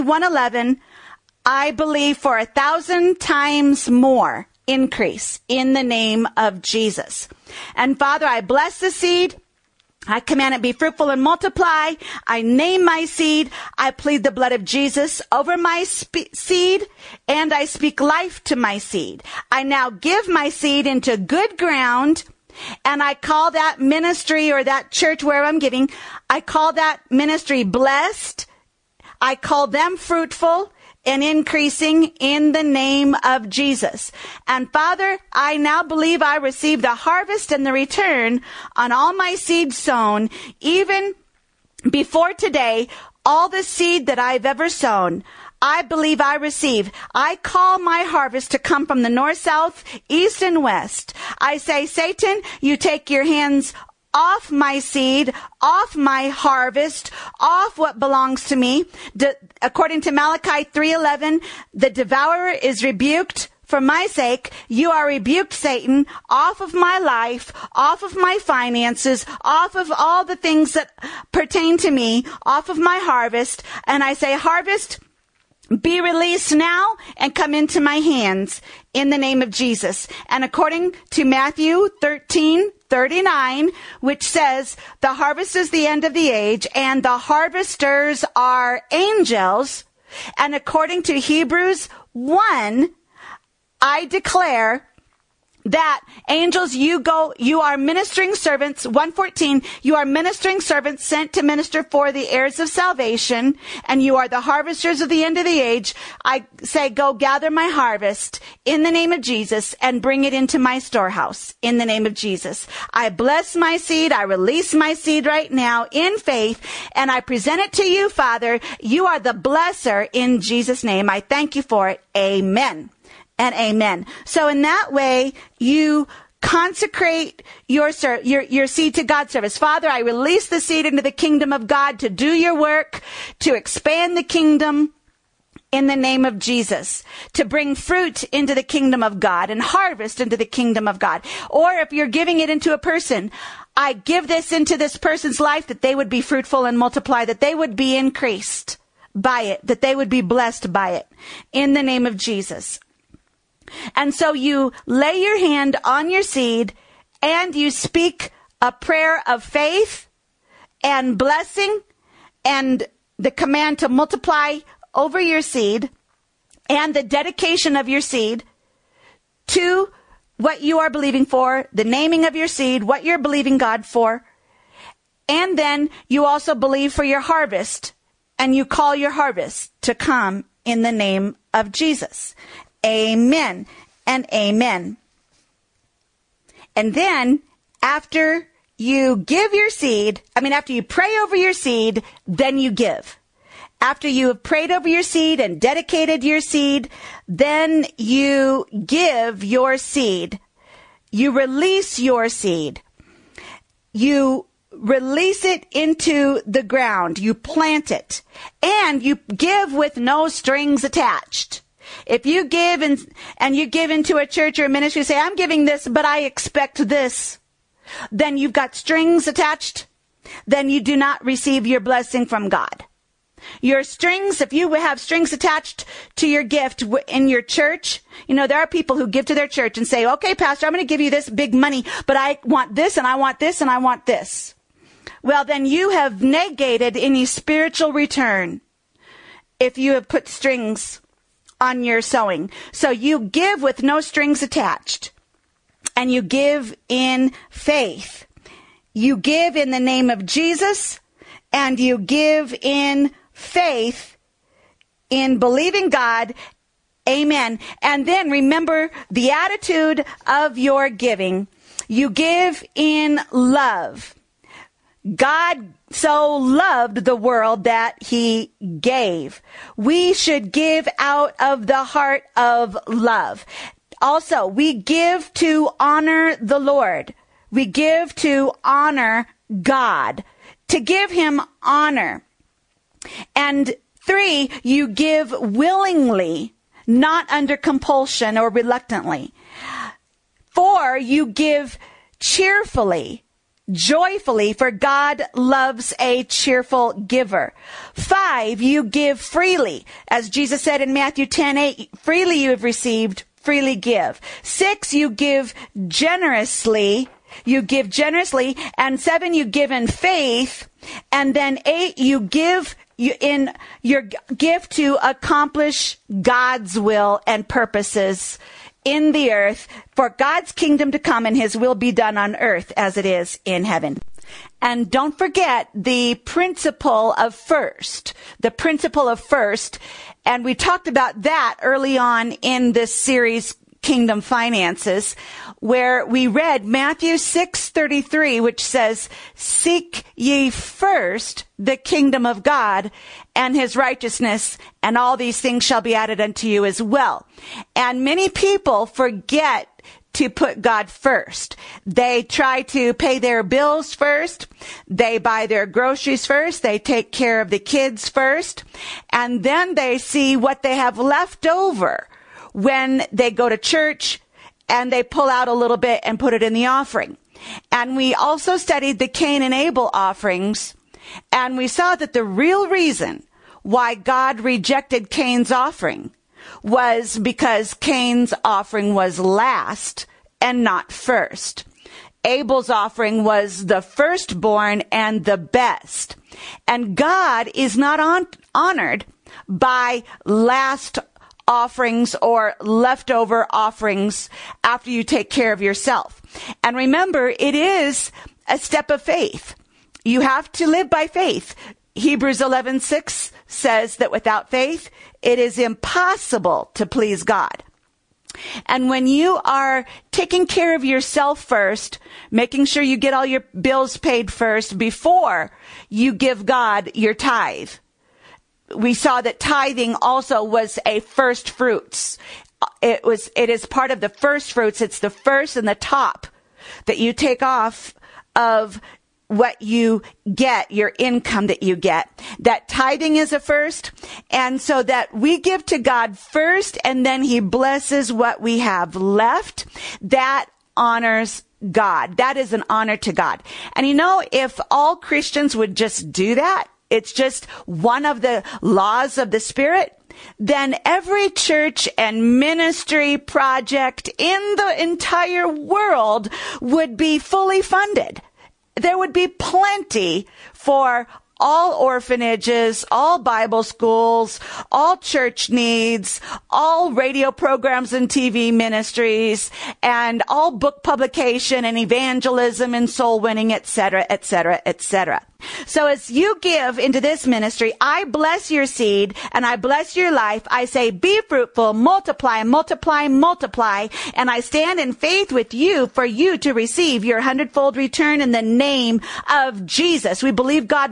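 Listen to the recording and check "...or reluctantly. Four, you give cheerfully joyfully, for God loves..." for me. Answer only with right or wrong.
right.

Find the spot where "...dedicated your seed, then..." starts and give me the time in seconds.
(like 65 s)
195 s.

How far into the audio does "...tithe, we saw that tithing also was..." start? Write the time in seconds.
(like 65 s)
417 s.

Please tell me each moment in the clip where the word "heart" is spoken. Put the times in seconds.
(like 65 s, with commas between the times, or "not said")
271 s.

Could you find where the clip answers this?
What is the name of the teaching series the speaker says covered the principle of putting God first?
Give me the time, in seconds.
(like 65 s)
333 s.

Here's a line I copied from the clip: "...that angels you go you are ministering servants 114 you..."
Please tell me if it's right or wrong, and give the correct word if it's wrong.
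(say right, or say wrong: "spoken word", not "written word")
right.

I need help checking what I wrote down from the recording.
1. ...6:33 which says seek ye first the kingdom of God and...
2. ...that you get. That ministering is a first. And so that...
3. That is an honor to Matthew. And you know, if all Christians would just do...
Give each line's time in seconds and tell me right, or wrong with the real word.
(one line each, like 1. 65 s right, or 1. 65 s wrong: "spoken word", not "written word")
1. 337 s right
2. 431 s wrong: "tithing", not "ministering"
3. 442 s wrong: "God", not "Matthew".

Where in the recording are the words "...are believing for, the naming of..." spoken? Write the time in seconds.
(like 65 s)
170 s.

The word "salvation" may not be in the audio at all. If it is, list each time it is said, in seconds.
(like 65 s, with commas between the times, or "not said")
102 s.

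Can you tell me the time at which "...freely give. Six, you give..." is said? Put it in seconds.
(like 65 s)
303 s.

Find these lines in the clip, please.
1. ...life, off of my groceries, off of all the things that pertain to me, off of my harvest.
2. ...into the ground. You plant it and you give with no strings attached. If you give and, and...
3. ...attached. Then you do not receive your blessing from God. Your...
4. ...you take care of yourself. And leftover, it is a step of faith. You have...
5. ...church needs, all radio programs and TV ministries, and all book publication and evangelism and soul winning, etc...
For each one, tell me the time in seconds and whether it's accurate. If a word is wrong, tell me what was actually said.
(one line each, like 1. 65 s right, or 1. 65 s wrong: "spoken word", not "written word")
1. 66 s wrong: "finances", not "groceries"
2. 205 s right
3. 219 s right
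4. 394 s wrong: "remember", not "leftover"
5. 464 s right.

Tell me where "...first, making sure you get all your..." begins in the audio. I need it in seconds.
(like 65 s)
411 s.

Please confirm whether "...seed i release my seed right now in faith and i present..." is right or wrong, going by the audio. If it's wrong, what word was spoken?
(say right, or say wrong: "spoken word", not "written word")
right.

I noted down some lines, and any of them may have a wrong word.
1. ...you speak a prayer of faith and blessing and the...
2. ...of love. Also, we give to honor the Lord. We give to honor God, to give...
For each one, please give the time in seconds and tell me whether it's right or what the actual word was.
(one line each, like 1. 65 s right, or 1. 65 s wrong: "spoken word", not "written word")
1. 157 s right
2. 272 s right.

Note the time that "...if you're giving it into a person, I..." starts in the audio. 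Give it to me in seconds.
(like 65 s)
141 s.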